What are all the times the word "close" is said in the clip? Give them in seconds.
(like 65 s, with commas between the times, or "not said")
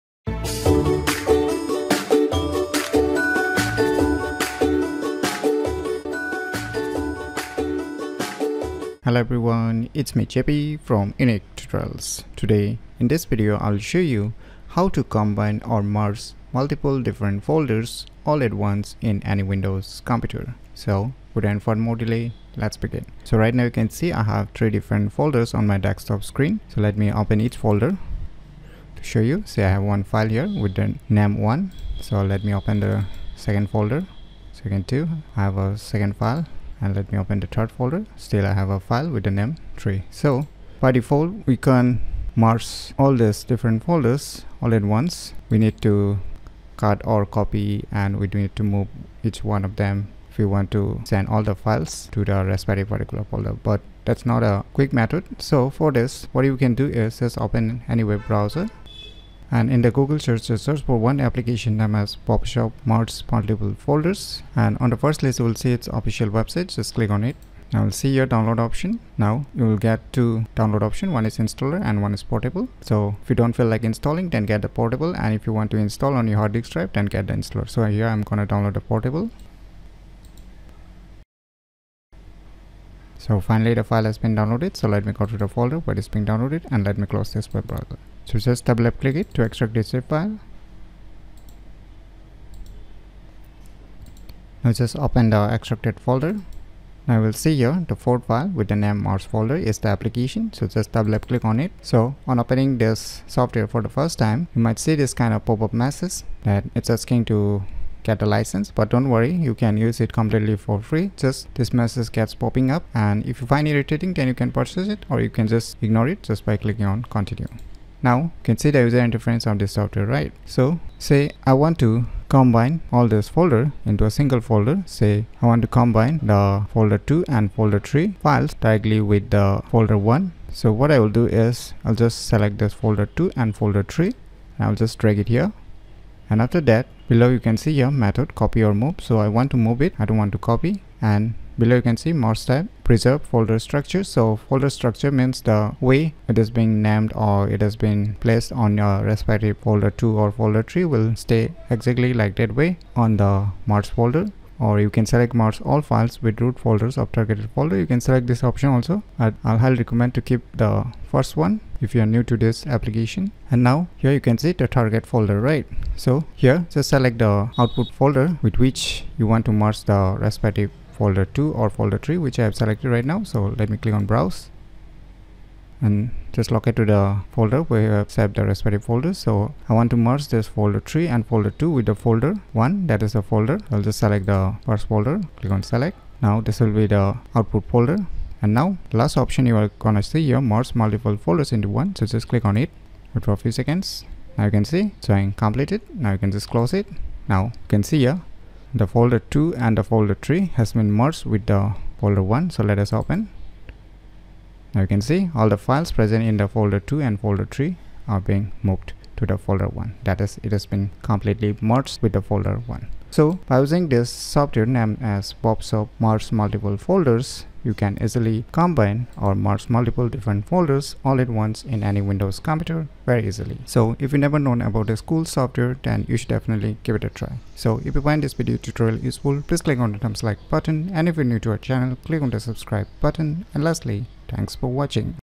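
87 s, 196 s.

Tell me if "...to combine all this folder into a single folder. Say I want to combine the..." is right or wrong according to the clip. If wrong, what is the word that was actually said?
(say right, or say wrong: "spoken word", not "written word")
right.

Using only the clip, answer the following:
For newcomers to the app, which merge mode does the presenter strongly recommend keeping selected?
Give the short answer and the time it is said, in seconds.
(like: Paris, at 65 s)
Preserve folder structure, at 142 s.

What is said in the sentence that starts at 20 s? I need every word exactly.
So, without further more delay, let's begin.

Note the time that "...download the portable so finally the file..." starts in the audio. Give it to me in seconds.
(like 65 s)
78 s.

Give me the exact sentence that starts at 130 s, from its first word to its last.
So what I will do is I'll just select this folder 2 and folder 3 and I'll just drag it here.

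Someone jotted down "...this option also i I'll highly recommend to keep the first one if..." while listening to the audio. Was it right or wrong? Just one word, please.
right.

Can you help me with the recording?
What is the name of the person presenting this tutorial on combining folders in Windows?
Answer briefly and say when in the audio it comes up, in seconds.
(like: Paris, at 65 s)
Jeppy, at 10 s.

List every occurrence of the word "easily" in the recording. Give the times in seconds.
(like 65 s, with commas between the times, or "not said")
218 s, 223 s.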